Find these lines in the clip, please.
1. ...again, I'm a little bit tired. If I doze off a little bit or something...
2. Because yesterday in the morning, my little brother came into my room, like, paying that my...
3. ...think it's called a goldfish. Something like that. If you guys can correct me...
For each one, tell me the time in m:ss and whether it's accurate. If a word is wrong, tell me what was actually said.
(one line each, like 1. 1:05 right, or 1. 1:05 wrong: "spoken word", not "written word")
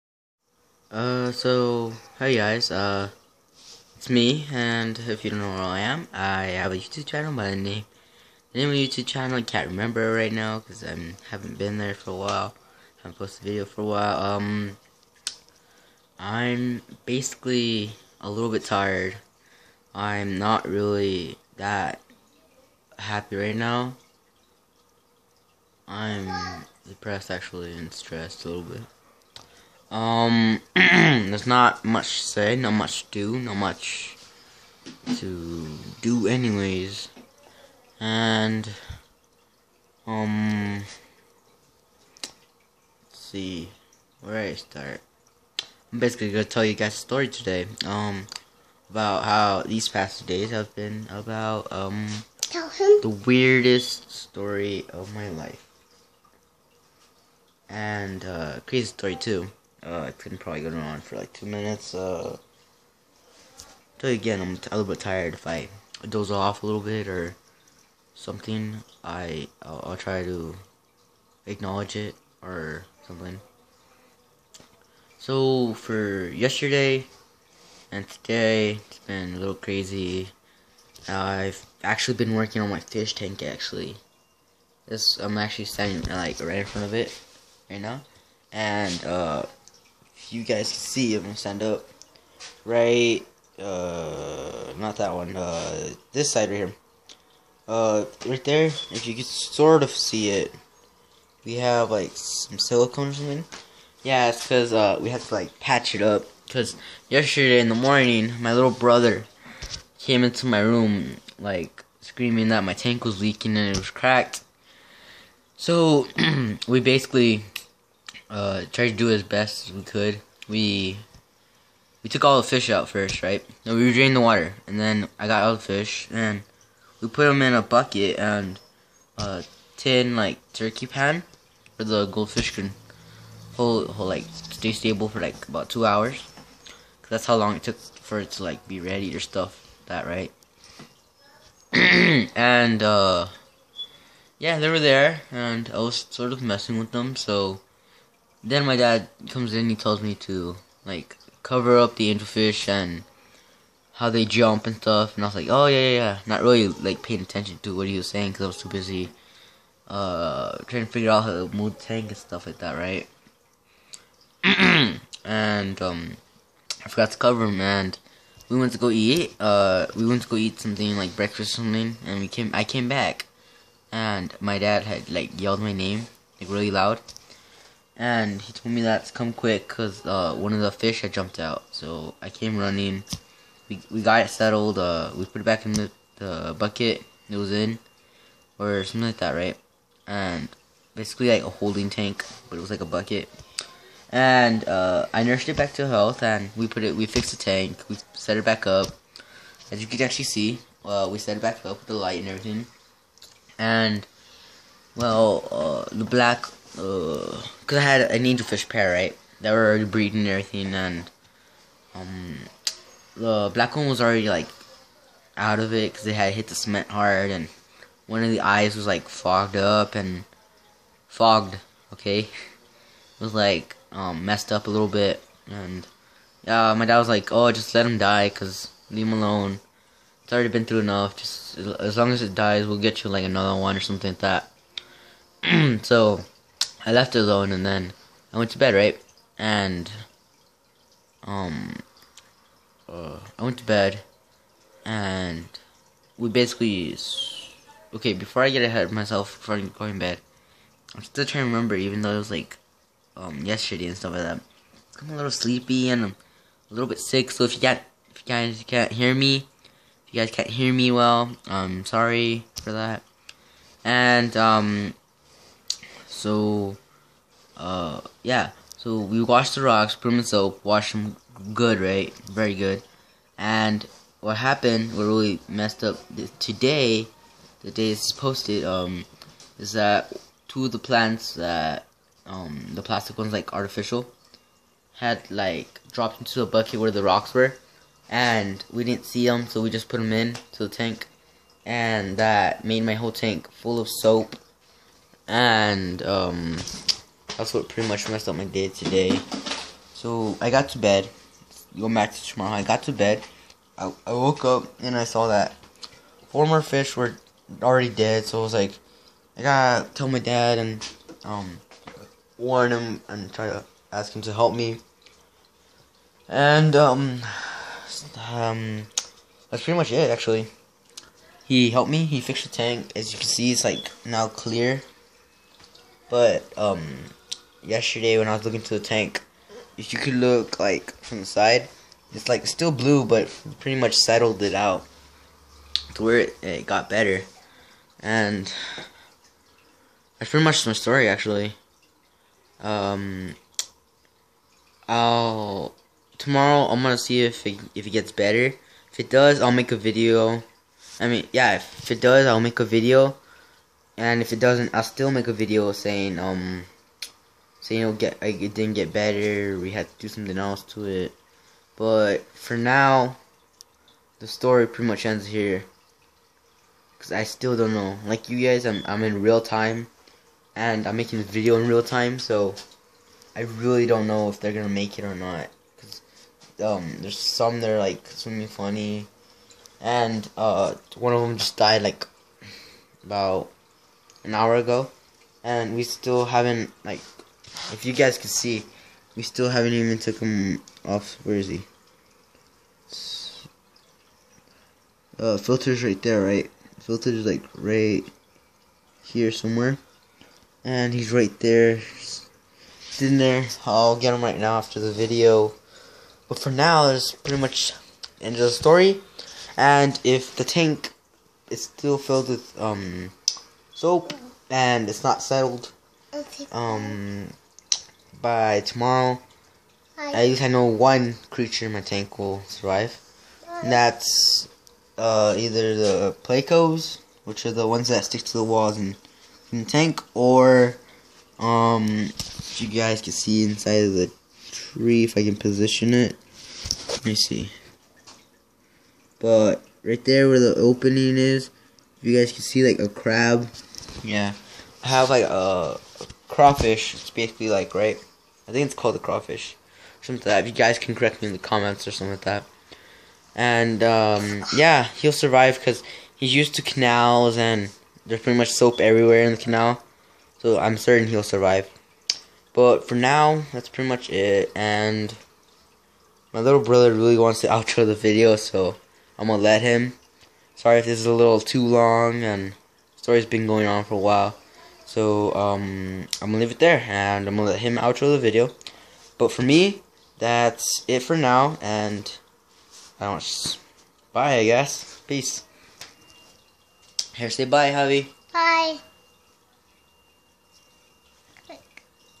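1. 1:04 right
2. 1:46 wrong: "screaming", not "paying"
3. 7:28 wrong: "crawfish", not "goldfish".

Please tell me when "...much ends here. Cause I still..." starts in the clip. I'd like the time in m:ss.
6:04.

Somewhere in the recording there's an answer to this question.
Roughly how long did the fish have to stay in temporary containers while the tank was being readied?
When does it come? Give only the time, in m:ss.
2:15.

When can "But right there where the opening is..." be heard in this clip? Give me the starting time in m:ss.
7:19.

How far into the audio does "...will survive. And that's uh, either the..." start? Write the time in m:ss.
7:02.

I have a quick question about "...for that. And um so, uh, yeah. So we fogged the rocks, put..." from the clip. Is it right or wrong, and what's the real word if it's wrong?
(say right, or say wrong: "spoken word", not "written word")
wrong: "washed", not "fogged".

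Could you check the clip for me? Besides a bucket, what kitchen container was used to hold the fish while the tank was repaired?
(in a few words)
turkey pan.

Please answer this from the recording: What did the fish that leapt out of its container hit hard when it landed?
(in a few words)
cement.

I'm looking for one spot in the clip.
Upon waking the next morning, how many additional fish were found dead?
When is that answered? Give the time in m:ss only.
5:06.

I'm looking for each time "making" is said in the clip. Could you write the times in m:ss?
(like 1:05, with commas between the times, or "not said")
6:10.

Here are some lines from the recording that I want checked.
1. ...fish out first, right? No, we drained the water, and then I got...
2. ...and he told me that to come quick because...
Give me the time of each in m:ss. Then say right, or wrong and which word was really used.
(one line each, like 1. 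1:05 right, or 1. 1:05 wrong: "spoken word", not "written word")
1. 2:02 right
2. 2:58 right.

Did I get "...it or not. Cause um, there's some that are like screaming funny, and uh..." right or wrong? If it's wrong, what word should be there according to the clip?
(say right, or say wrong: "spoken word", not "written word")
wrong: "swimming", not "screaming".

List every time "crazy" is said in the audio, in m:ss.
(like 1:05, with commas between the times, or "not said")
0:58, 1:19.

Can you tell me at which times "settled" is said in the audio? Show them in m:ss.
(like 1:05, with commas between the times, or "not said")
3:04, 5:33, 6:55.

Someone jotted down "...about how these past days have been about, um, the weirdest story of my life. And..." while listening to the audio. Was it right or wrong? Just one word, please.
right.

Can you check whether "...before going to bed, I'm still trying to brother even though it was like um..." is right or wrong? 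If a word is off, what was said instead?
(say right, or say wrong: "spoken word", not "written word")
wrong: "remember", not "brother".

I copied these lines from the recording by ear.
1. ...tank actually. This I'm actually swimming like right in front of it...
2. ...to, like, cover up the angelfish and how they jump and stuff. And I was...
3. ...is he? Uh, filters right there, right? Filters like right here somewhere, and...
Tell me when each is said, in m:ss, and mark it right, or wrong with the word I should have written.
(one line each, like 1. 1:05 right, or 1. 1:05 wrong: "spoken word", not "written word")
1. 1:23 wrong: "standing", not "swimming"
2. 2:30 right
3. 6:31 right.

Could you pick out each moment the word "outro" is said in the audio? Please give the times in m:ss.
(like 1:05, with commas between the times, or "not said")
7:47, 7:57.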